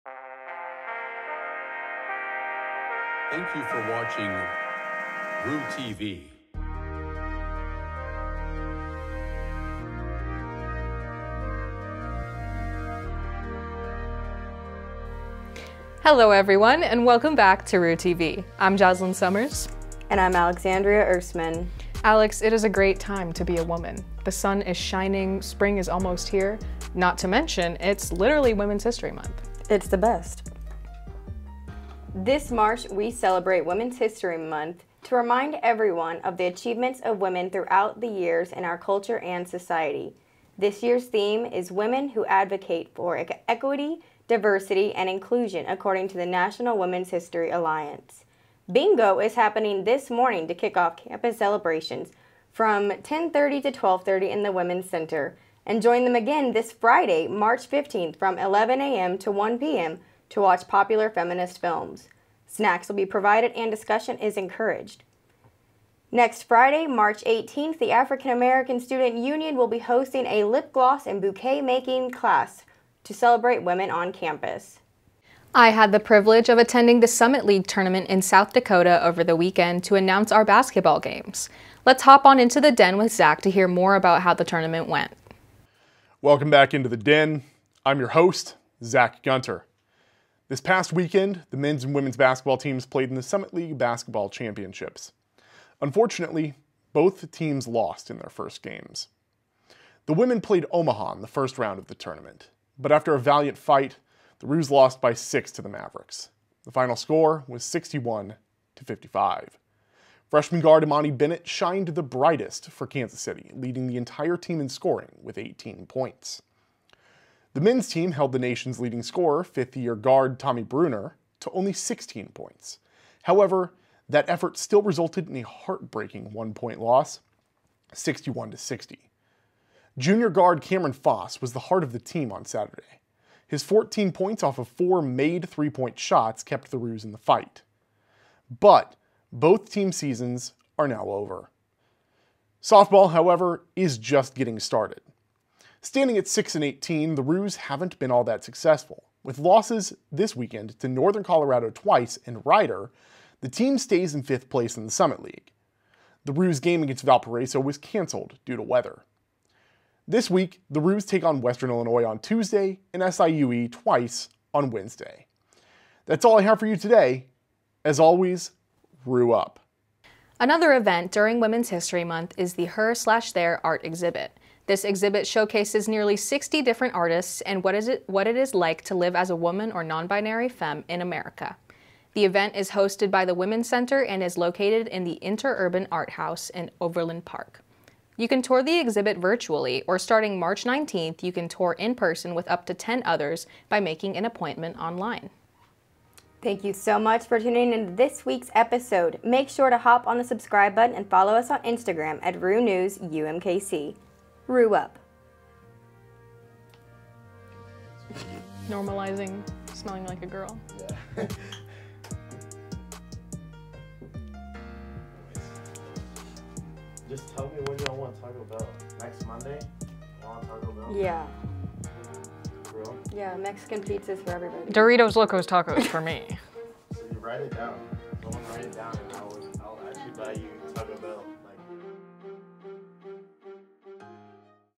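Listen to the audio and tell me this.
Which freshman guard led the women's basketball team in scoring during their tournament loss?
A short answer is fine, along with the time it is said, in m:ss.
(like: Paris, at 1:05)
Imani Bennett, at 1:50.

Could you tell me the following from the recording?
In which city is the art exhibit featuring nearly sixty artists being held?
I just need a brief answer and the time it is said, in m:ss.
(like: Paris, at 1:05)
Overland Park, at 3:06.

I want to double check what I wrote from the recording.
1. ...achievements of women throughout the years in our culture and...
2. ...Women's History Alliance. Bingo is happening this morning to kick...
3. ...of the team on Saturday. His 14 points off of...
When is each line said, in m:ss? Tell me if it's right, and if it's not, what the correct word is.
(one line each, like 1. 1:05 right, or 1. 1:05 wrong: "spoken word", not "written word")
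1. 0:36 right
2. 0:46 right
3. 2:11 right.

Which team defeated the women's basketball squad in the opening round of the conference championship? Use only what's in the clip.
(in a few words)
Omaha.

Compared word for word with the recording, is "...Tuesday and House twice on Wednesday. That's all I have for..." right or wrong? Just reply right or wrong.
wrong.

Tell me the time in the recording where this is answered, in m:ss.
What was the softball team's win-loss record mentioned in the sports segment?
2:26.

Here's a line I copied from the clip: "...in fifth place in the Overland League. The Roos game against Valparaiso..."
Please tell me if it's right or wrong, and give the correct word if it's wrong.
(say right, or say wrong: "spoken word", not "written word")
wrong: "Summit", not "Overland".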